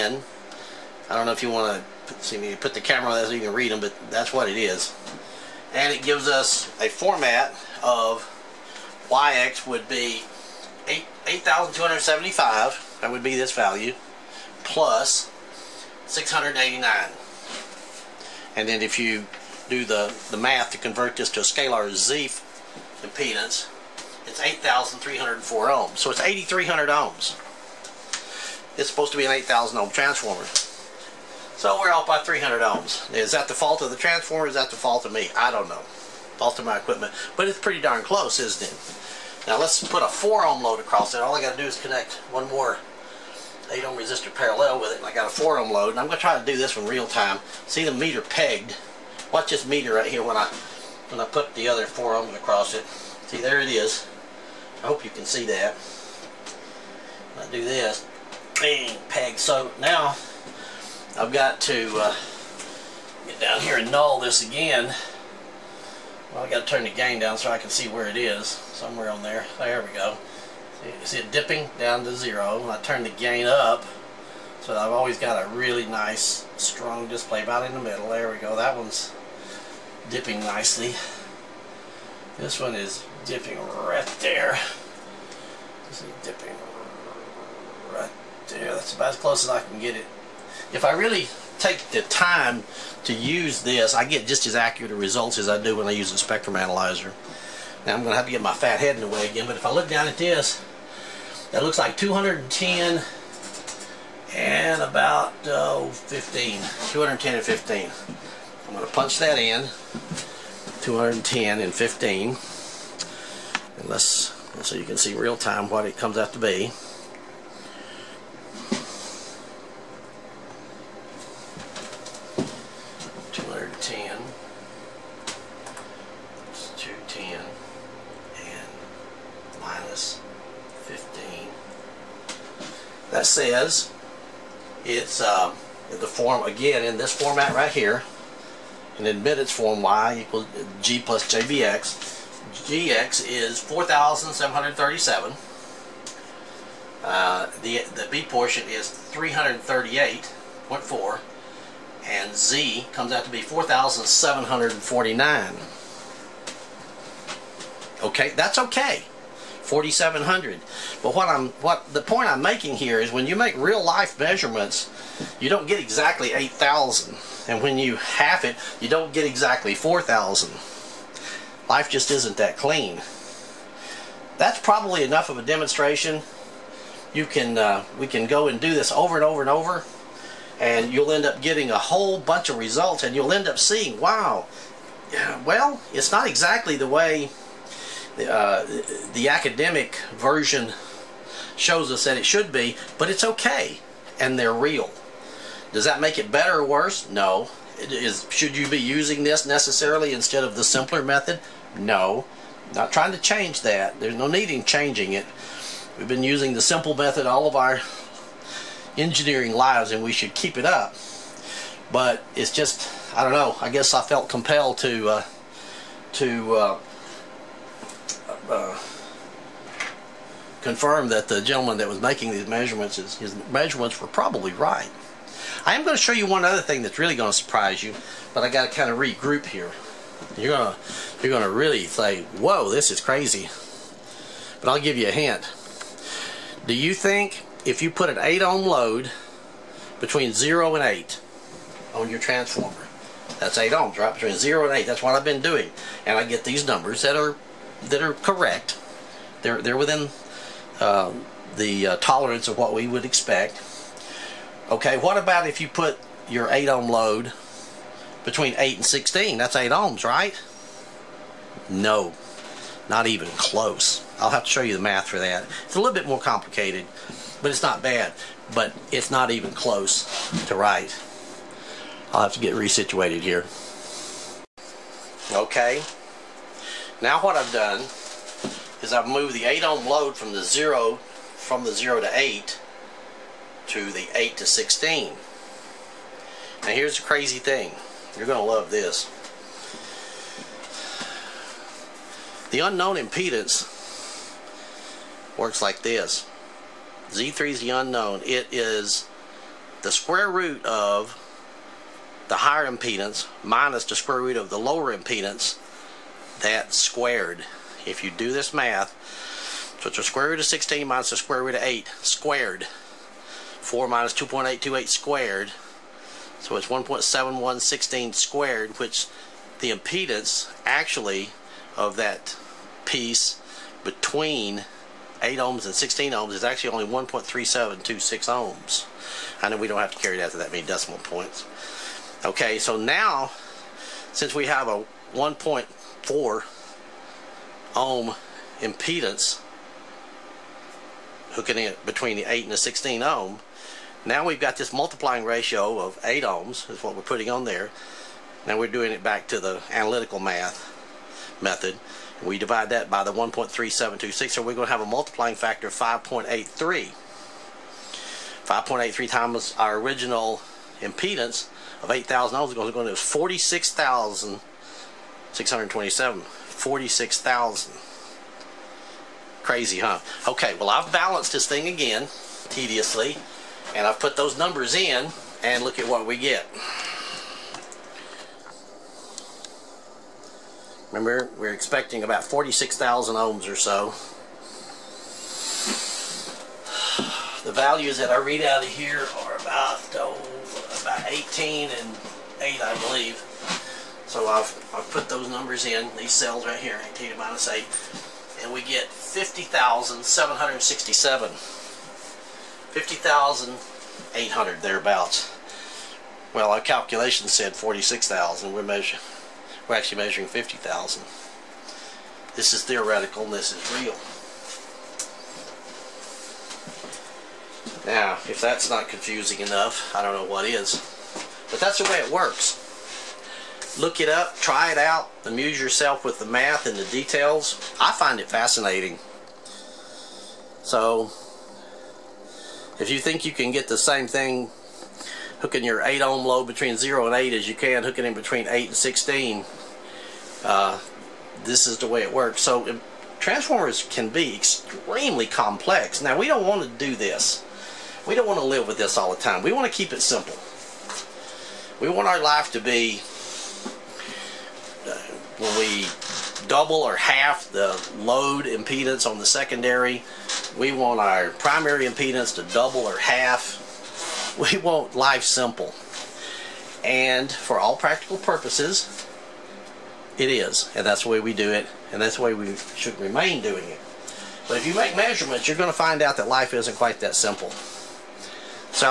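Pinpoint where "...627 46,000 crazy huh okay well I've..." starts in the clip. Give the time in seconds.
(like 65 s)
365 s.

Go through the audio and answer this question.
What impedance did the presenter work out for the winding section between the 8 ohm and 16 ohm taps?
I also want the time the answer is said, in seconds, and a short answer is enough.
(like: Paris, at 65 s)
1.3726 ohms, at 326 s.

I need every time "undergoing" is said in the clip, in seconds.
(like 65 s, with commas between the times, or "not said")
not said.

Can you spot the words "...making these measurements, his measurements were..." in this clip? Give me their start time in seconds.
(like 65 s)
222 s.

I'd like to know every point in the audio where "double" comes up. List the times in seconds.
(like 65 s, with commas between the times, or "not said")
456 s, 462 s.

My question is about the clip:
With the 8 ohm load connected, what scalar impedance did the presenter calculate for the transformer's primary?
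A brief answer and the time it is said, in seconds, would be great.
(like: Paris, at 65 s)
8,304 ohms, at 24 s.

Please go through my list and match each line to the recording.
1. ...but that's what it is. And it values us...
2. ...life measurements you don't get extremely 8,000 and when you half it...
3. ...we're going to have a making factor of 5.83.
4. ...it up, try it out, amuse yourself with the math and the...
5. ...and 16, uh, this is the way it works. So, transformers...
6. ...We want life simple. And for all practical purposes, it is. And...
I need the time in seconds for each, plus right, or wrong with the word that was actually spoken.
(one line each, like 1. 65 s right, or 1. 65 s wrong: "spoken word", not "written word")
1. 3 s wrong: "gives", not "values"
2. 163 s wrong: "exactly", not "extremely"
3. 354 s wrong: "multiplying", not "making"
4. 424 s right
5. 438 s right
6. 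464 s right.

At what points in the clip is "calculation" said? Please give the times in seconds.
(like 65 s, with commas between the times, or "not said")
406 s.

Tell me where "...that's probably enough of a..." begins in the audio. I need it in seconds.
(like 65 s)
174 s.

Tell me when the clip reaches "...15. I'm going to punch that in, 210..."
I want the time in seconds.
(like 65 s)
107 s.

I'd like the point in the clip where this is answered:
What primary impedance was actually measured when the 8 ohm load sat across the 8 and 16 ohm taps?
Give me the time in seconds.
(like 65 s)
398 s.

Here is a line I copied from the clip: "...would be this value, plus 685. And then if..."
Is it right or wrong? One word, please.
wrong.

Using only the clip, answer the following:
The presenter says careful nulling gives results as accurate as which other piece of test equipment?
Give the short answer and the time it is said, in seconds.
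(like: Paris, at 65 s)
spectrum analyzer, at 96 s.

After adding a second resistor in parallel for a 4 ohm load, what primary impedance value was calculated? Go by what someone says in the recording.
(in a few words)
4,749.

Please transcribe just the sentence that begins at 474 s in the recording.
But if you make measurements, you're going to find out that life isn't quite that simple.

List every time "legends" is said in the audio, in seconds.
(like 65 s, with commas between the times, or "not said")
not said.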